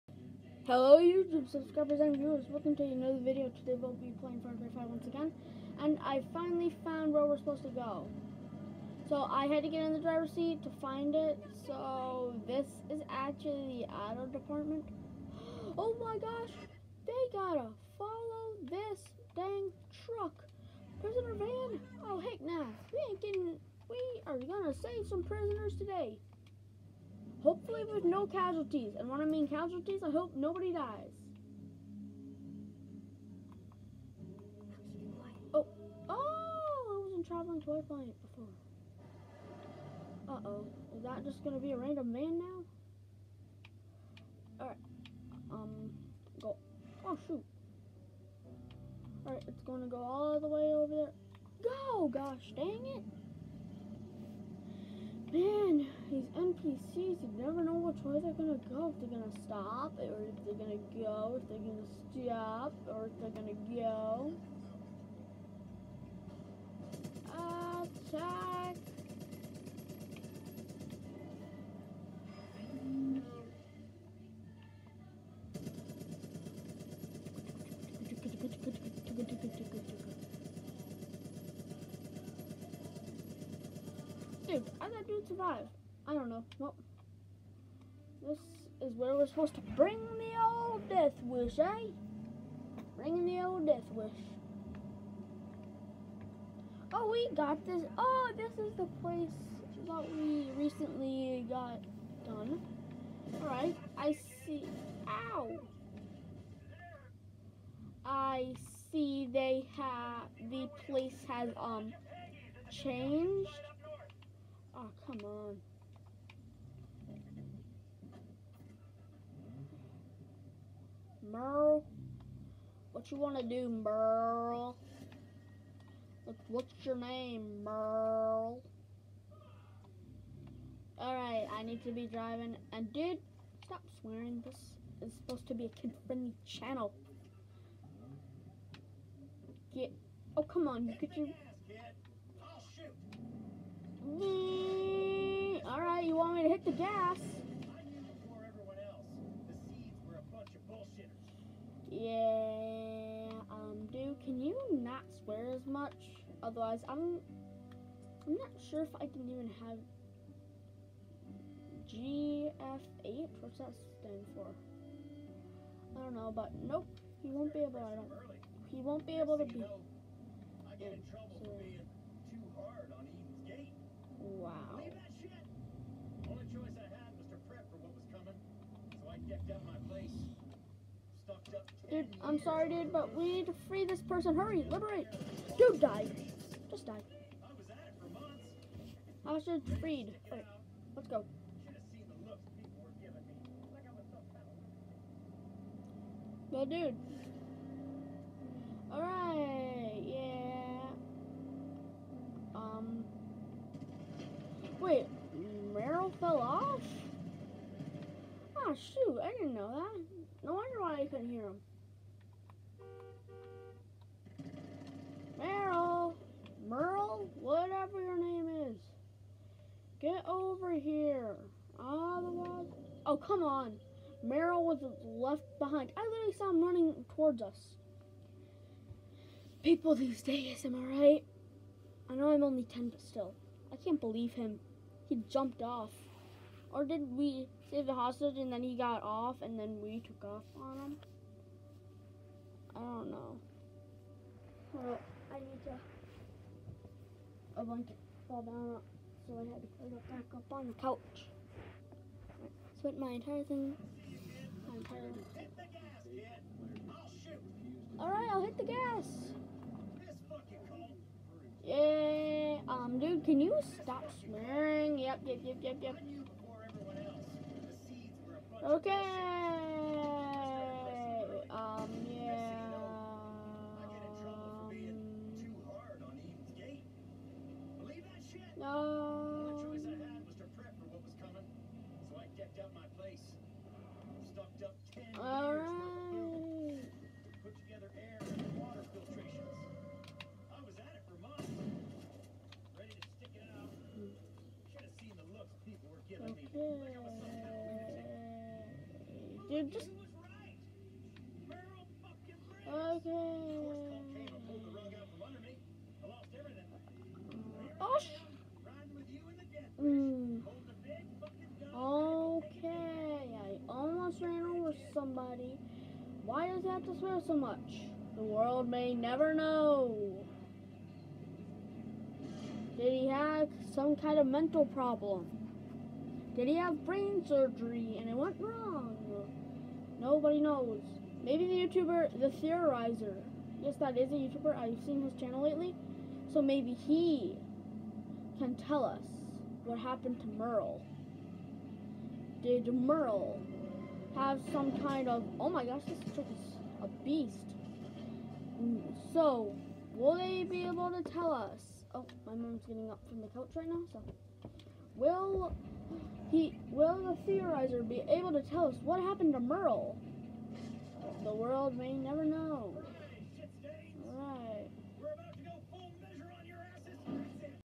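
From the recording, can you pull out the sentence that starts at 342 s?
Did Merle have some kind of, oh my gosh, this trick is a beast.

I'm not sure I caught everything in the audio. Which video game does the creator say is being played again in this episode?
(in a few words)
Far Cry 5.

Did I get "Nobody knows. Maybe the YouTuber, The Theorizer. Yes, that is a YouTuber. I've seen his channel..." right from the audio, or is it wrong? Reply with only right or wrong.
right.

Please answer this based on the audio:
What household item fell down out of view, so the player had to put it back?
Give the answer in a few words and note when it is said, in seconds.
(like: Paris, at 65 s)
A blanket, at 247 s.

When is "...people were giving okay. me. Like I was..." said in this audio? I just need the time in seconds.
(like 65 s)
295 s.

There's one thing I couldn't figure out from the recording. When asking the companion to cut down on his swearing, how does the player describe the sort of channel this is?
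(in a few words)
Kid-friendly.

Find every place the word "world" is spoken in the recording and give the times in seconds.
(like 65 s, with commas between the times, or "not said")
318 s, 361 s.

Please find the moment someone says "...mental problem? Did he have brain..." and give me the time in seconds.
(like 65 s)
324 s.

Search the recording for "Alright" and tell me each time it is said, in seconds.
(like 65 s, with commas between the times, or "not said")
44 s, 49 s, 103 s, 130 s, 145 s, 198 s, 257 s.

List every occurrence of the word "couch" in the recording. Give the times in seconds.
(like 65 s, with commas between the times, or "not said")
250 s, 353 s.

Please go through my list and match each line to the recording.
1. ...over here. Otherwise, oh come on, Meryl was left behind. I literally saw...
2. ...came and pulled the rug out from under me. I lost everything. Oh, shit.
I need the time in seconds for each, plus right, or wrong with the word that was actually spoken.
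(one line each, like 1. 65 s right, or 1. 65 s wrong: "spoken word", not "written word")
1. 220 s right
2. 304 s right.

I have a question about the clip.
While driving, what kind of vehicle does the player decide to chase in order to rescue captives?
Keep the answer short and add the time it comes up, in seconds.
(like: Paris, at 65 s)
Prisoner van, at 21 s.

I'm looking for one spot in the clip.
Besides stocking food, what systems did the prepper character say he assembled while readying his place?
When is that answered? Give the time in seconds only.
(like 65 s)
287 s.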